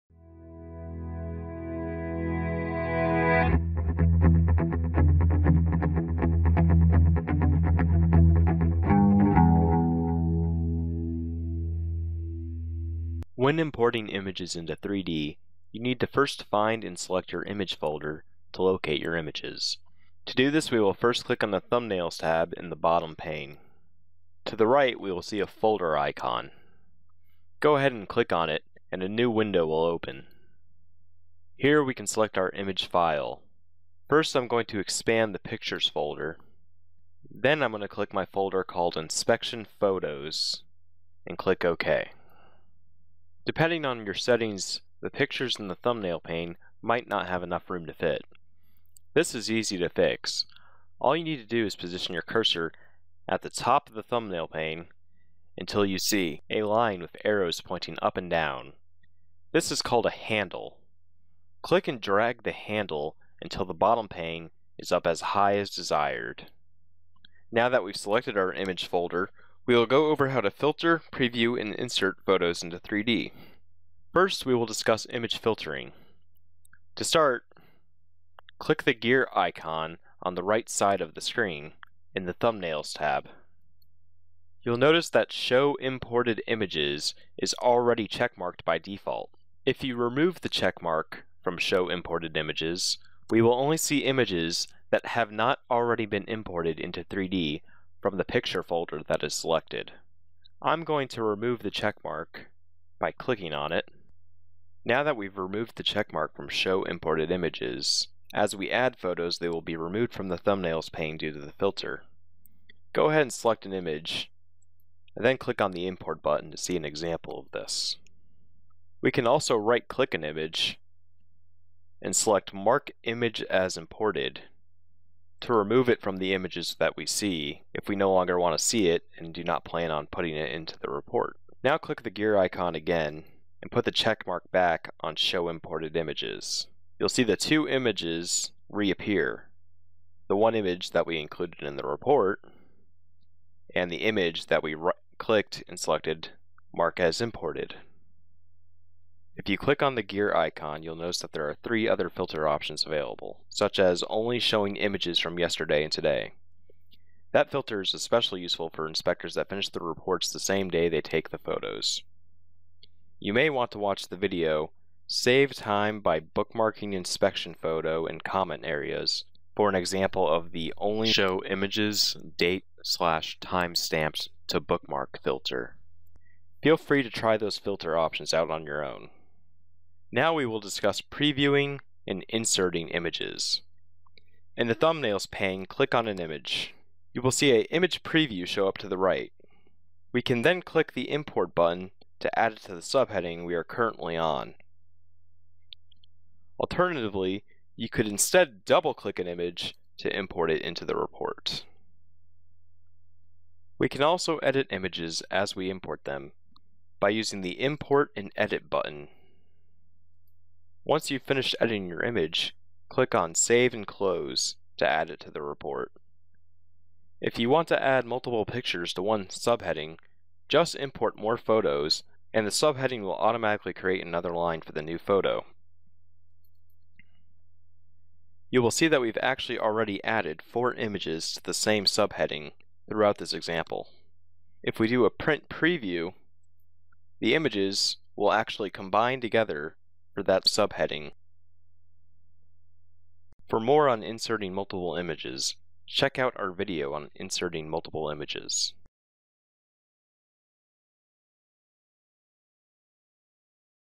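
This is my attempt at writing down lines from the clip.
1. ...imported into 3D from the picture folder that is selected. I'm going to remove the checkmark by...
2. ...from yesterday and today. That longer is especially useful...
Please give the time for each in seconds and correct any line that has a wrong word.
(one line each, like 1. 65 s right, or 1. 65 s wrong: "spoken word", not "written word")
1. 96 s right
2. 155 s wrong: "filter", not "longer".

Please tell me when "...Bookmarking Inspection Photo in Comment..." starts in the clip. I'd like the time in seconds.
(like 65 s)
166 s.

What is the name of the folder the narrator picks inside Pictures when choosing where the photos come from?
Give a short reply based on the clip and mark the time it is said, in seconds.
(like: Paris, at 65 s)
Inspection Photos, at 38 s.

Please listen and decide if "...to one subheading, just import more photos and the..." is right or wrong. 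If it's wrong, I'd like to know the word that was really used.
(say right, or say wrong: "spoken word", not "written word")
right.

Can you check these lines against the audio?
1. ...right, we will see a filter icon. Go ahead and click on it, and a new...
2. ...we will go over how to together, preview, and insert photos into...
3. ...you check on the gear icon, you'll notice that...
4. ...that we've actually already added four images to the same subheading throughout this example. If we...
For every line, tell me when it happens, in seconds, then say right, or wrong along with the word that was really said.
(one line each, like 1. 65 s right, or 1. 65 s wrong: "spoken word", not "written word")
1. 24 s wrong: "folder", not "filter"
2. 69 s wrong: "filter", not "together"
3. 149 s wrong: "click", not "check"
4. 228 s right.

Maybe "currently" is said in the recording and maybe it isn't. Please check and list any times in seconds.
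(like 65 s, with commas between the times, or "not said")
193 s.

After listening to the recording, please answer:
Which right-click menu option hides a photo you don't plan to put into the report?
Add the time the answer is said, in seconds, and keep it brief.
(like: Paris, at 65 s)
Mark Image as Imported, at 122 s.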